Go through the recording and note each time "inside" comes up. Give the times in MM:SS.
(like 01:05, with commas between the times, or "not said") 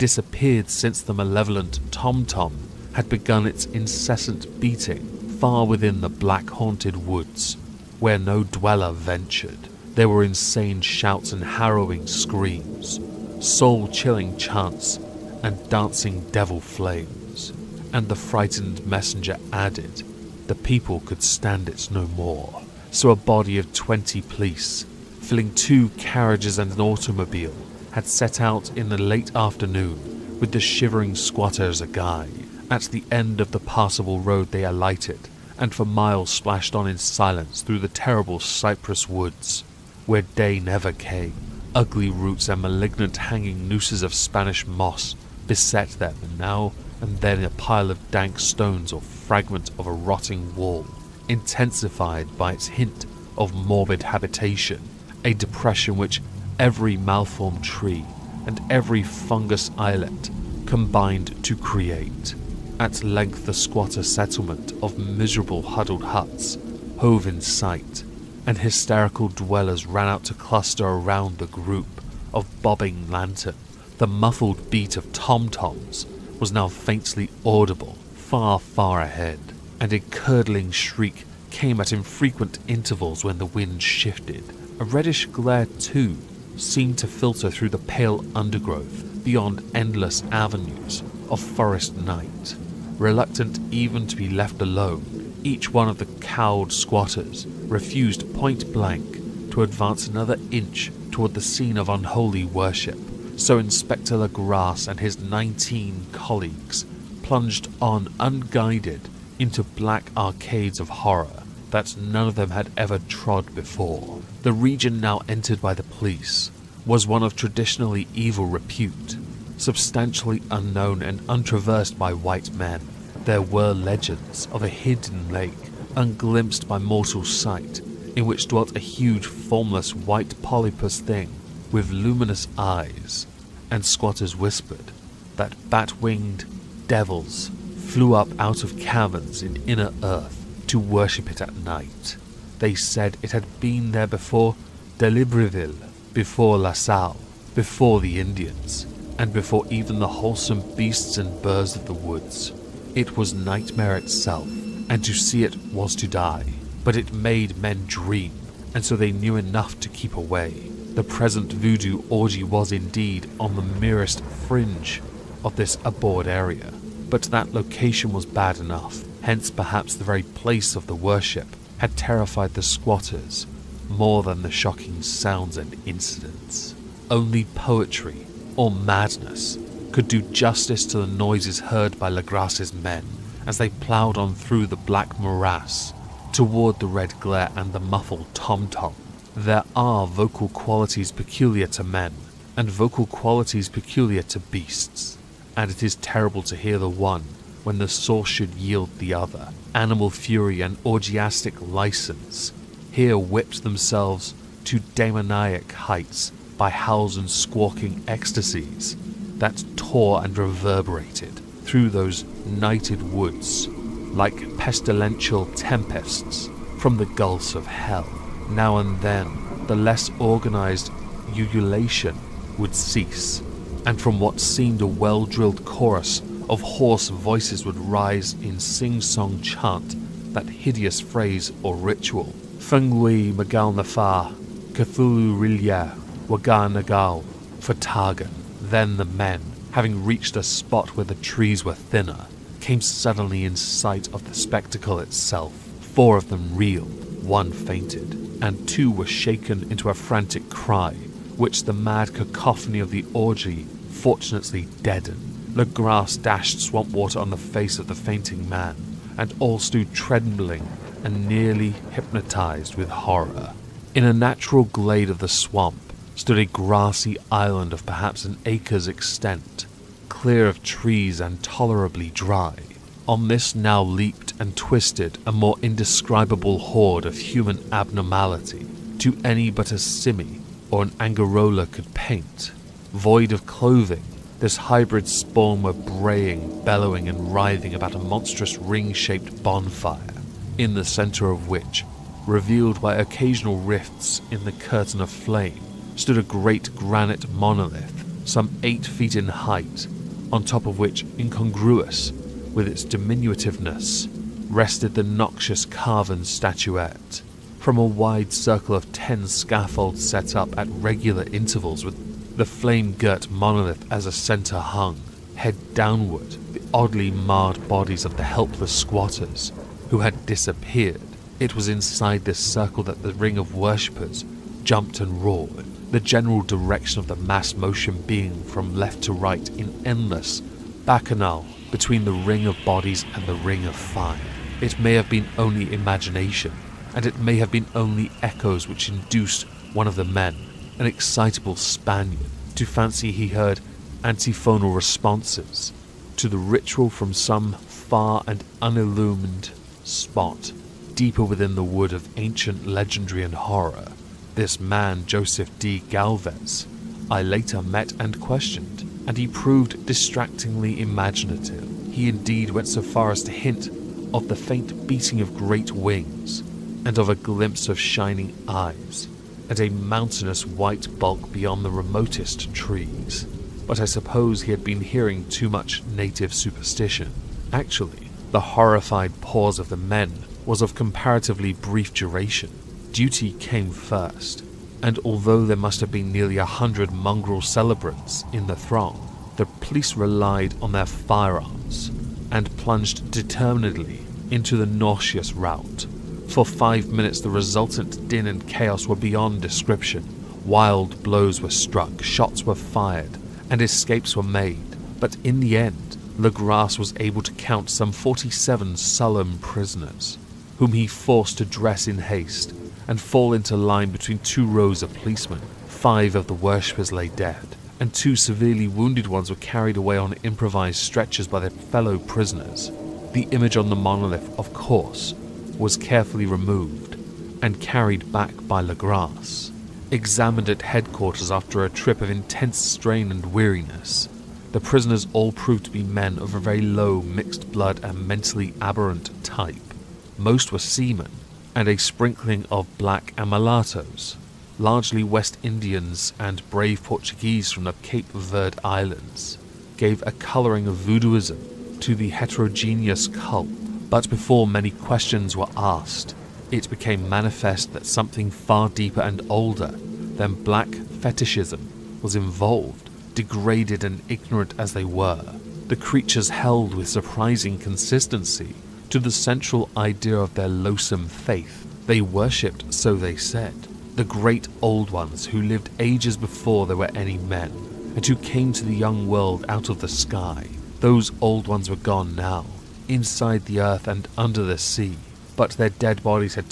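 05:21, 08:02.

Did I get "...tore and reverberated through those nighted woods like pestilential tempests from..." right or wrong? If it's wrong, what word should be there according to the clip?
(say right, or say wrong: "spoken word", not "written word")
right.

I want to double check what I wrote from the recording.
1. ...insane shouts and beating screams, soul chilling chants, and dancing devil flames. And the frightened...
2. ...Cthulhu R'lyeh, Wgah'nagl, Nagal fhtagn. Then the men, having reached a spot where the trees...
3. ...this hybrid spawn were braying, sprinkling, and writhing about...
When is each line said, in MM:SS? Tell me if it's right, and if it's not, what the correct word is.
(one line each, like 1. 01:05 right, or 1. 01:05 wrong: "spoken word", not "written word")
1. 00:10 wrong: "harrowing", not "beating"
2. 03:54 right
3. 04:44 wrong: "bellowing", not "sprinkling".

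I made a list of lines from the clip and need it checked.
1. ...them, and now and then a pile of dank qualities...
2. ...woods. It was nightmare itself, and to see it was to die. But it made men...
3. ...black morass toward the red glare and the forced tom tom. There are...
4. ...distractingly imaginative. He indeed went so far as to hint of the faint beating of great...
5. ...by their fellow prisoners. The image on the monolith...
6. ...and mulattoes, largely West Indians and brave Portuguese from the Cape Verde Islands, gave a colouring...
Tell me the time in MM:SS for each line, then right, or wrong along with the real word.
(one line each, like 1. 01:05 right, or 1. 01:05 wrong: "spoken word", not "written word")
1. 00:45 wrong: "stones", not "qualities"
2. 02:31 right
3. 03:04 wrong: "muffled", not "forced"
4. 05:59 right
5. 07:01 right
6. 07:23 right.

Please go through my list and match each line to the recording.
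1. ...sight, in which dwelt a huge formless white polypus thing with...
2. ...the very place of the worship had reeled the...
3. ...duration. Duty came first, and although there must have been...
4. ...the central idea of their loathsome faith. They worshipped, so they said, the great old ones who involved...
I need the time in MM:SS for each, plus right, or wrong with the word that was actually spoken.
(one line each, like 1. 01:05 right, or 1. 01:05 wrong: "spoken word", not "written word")
1. 02:07 right
2. 02:49 wrong: "terrified", not "reeled"
3. 06:21 right
4. 07:48 wrong: "lived", not "involved".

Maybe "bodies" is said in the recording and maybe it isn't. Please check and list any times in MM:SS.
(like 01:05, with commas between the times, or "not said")
05:17, 05:32.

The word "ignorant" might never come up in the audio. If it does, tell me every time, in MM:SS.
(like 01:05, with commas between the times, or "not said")
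07:44.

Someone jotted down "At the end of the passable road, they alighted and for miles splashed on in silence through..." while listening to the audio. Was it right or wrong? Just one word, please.
right.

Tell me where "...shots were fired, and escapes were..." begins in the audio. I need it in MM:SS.
06:42.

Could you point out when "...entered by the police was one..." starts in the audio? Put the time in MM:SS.
01:55.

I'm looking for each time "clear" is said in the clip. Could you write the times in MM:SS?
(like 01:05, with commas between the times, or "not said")
04:30.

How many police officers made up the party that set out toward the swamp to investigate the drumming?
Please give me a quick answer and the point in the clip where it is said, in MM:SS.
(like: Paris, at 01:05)
20, at 00:23.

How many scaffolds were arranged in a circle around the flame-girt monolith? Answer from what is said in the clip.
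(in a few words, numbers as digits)
10.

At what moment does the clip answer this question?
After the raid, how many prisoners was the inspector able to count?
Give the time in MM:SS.
06:47.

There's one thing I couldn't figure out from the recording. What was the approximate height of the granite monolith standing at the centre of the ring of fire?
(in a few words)
8 feet.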